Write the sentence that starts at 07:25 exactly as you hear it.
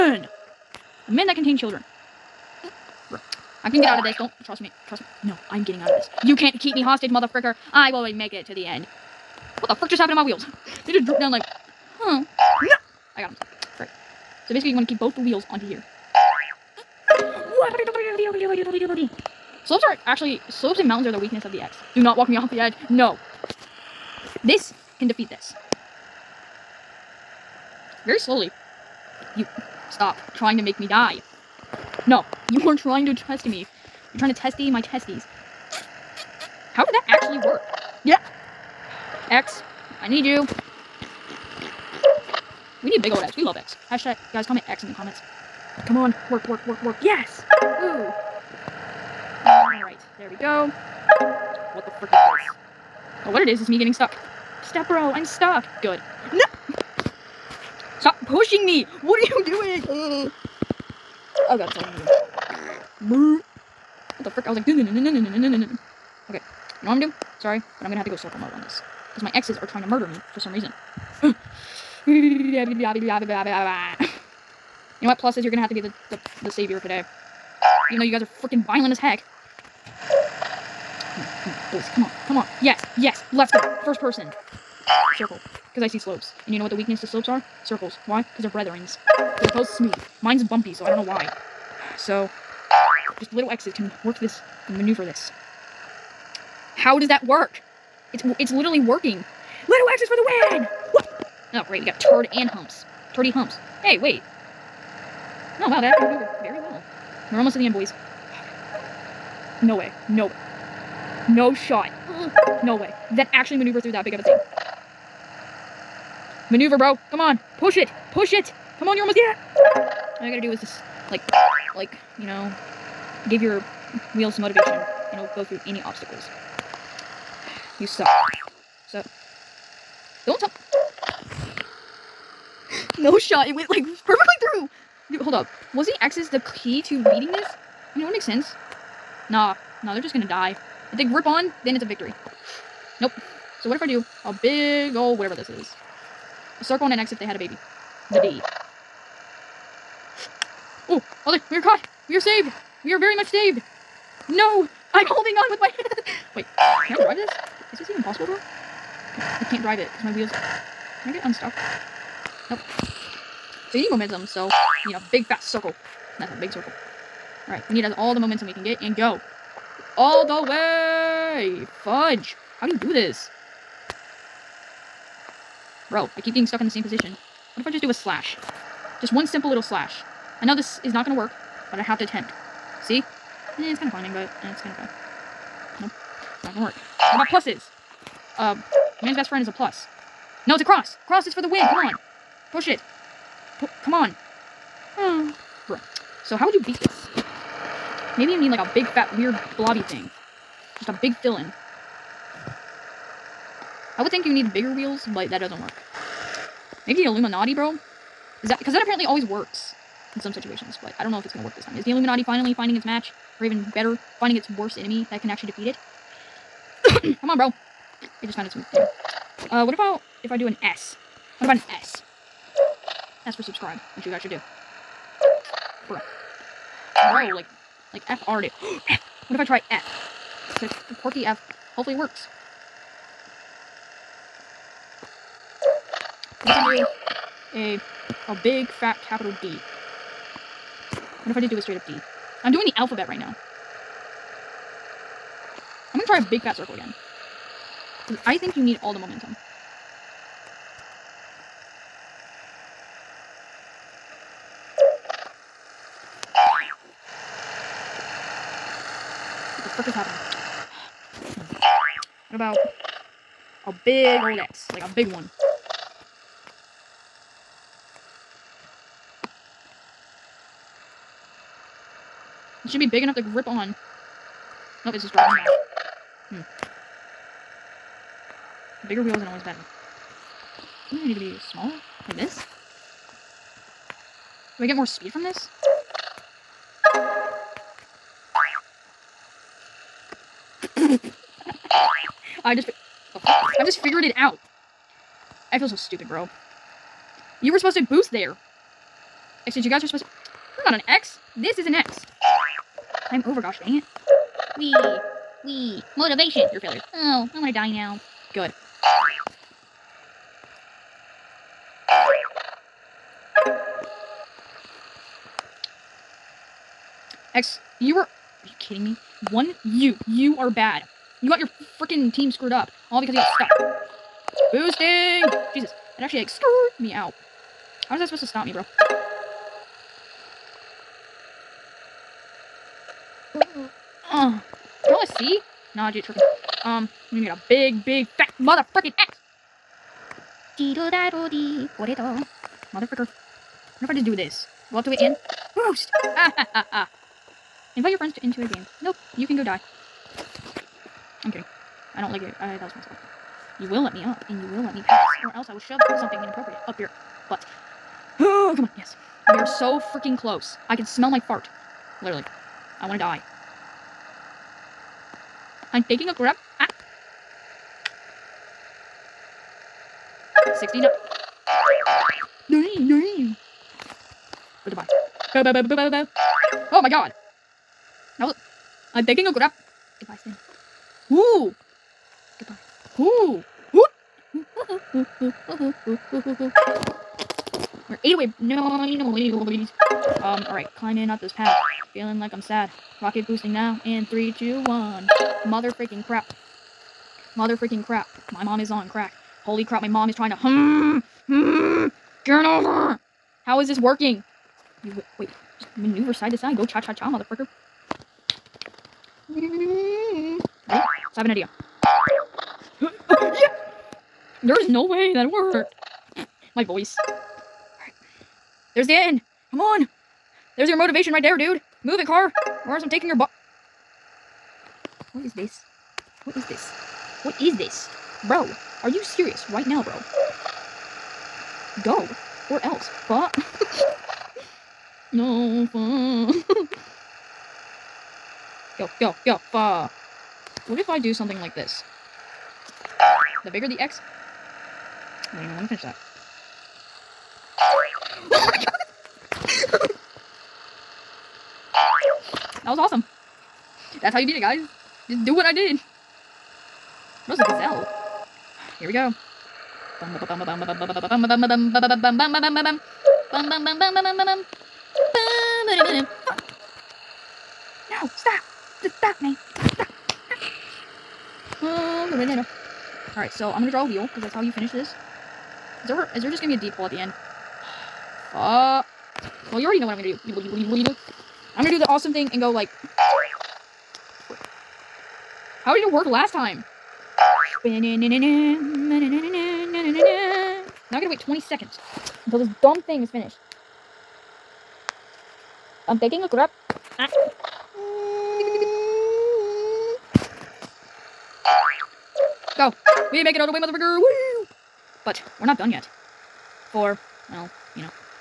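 I don't even want to finish that.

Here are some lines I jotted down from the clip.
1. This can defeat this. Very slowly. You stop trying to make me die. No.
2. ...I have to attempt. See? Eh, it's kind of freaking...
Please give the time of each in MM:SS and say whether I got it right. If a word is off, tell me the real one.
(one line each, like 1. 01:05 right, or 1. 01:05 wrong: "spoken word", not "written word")
1. 00:24 right
2. 03:01 wrong: "climbing", not "freaking".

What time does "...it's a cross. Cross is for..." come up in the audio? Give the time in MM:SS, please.
03:10.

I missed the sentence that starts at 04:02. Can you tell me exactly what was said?
I'm doing the alphabet right now.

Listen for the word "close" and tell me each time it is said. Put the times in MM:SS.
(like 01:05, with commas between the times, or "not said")
06:00.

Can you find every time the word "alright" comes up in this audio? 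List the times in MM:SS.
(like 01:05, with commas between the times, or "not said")
02:47, 06:30, 07:53.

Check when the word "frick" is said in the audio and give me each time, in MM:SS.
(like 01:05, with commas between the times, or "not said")
00:09, 00:51, 01:04.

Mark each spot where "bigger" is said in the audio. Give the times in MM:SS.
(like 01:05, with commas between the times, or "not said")
03:24, 04:38, 07:23.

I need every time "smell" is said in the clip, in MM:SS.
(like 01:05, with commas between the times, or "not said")
06:00.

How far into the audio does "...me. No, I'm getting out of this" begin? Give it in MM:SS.
00:05.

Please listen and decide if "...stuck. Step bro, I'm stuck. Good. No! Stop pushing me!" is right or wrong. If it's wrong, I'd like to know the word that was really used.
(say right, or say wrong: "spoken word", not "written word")
right.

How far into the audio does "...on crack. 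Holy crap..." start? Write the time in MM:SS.
06:38.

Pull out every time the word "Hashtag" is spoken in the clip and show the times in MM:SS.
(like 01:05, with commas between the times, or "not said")
00:43.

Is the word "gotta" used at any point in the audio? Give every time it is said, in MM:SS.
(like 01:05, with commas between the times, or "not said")
02:00, 08:10.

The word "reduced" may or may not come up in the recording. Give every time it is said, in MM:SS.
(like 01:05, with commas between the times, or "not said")
not said.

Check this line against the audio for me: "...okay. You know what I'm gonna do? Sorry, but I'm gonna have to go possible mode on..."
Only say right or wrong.
wrong.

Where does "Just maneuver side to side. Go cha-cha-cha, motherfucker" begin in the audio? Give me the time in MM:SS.
06:45.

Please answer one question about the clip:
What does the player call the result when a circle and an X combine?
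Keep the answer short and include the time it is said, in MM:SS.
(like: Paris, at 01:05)
The D, at 02:28.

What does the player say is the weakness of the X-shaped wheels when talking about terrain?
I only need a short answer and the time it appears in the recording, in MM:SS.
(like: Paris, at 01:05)
Slopes and mountains, at 00:20.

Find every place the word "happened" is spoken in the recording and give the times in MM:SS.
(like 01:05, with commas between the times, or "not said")
00:09, 04:19.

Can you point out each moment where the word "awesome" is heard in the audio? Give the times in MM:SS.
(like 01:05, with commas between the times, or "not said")
07:32, 08:01.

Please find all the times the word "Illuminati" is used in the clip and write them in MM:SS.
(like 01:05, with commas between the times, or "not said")
03:27, 03:31.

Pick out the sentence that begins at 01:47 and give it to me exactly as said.
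We're almost to the end, boys.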